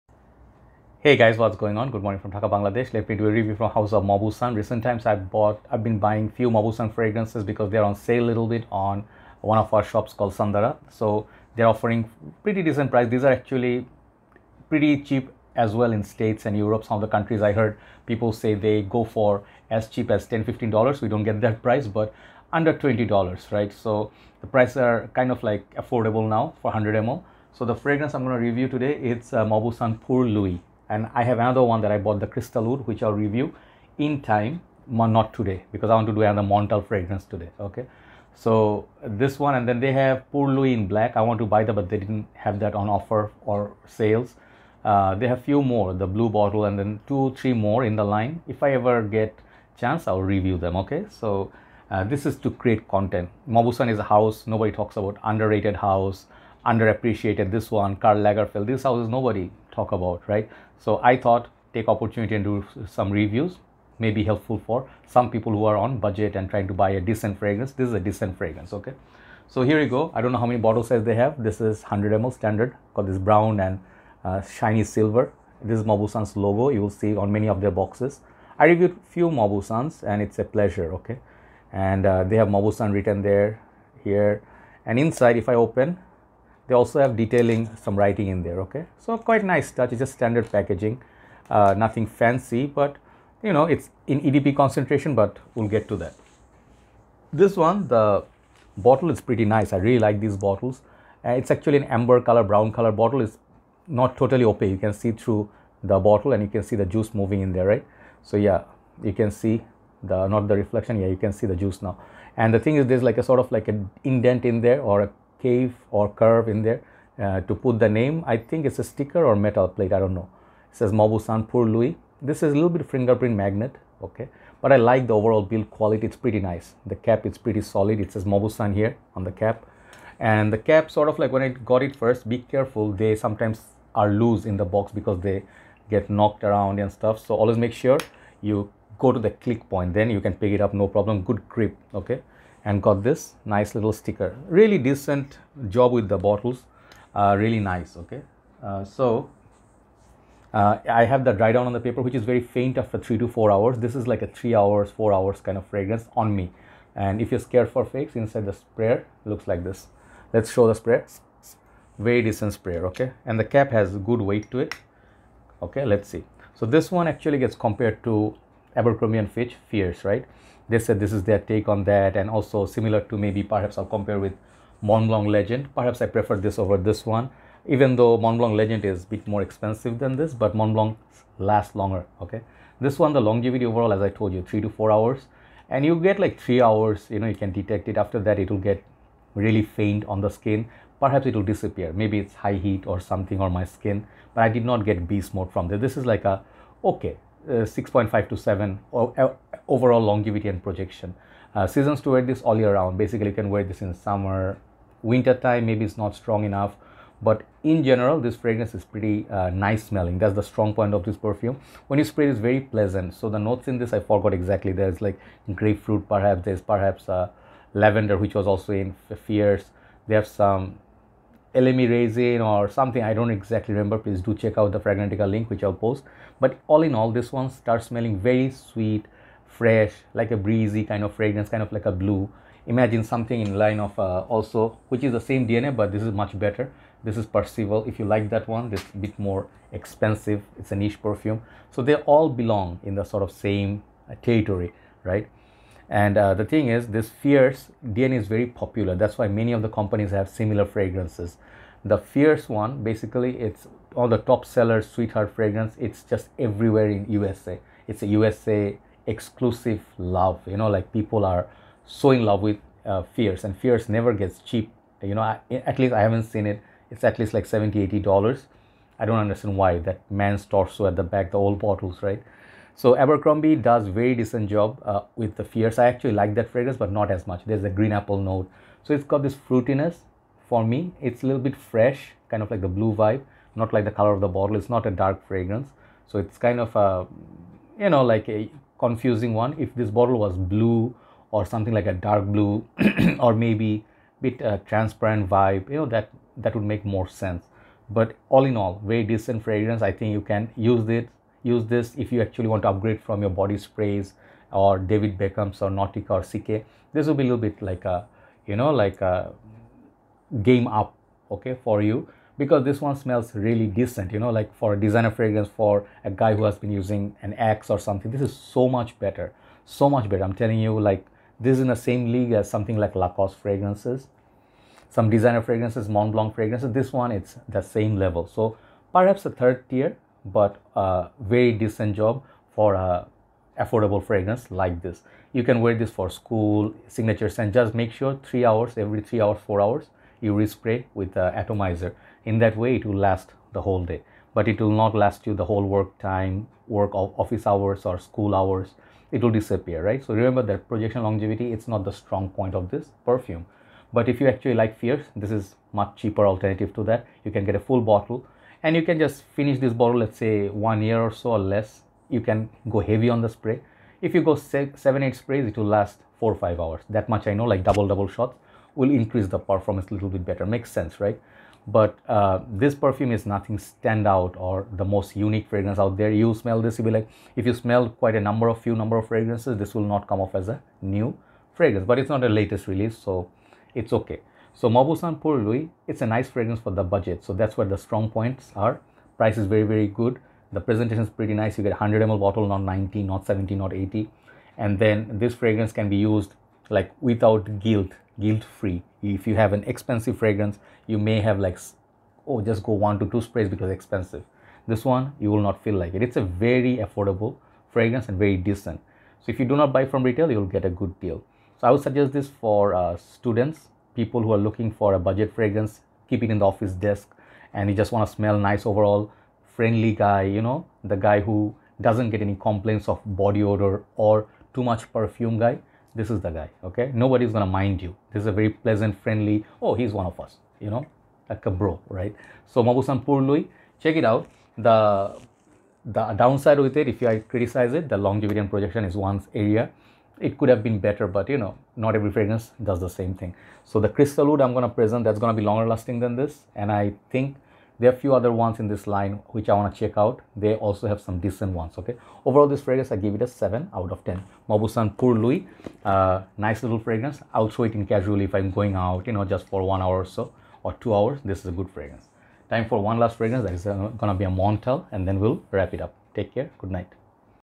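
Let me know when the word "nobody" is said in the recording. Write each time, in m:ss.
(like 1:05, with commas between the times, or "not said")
0:54, 0:59, 7:06.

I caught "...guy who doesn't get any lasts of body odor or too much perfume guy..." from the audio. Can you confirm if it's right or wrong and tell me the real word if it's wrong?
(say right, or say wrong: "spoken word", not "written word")
wrong: "complaints", not "lasts".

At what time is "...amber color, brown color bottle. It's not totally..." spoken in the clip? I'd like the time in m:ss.
1:41.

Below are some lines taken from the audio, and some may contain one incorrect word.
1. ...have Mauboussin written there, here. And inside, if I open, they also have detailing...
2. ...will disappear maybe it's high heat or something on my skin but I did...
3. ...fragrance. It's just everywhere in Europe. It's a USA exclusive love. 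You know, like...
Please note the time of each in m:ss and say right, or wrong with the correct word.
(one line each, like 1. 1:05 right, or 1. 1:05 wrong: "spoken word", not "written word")
1. 1:22 right
2. 3:11 right
3. 4:15 wrong: "USA", not "Europe".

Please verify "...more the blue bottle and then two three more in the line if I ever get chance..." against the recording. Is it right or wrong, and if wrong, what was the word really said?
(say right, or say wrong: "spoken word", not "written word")
right.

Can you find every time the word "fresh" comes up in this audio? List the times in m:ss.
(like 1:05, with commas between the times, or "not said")
3:49, 4:41.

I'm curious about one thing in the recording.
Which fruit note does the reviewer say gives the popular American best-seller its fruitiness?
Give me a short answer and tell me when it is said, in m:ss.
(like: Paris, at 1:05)
green apple, at 4:37.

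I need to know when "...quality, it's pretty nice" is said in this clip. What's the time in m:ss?
2:05.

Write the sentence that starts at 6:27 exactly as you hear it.
So that's where the strong points are.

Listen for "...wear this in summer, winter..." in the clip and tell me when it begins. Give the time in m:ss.
3:23.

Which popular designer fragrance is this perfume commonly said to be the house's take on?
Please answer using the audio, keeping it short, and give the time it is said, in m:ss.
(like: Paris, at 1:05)
Abercrombie and Fitch Fierce, at 2:48.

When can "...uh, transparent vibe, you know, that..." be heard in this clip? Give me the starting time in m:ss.
4:54.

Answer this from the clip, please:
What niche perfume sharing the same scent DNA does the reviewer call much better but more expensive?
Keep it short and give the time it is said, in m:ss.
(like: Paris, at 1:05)
Percival, at 3:57.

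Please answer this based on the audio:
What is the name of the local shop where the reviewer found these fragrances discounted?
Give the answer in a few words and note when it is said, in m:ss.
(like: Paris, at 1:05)
Sandara, at 0:10.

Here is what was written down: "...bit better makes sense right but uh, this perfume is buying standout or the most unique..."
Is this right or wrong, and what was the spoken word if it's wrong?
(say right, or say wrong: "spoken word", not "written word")
wrong: "nothing", not "buying".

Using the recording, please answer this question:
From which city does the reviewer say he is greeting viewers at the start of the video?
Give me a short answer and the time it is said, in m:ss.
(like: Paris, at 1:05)
Dhaka, at 0:02.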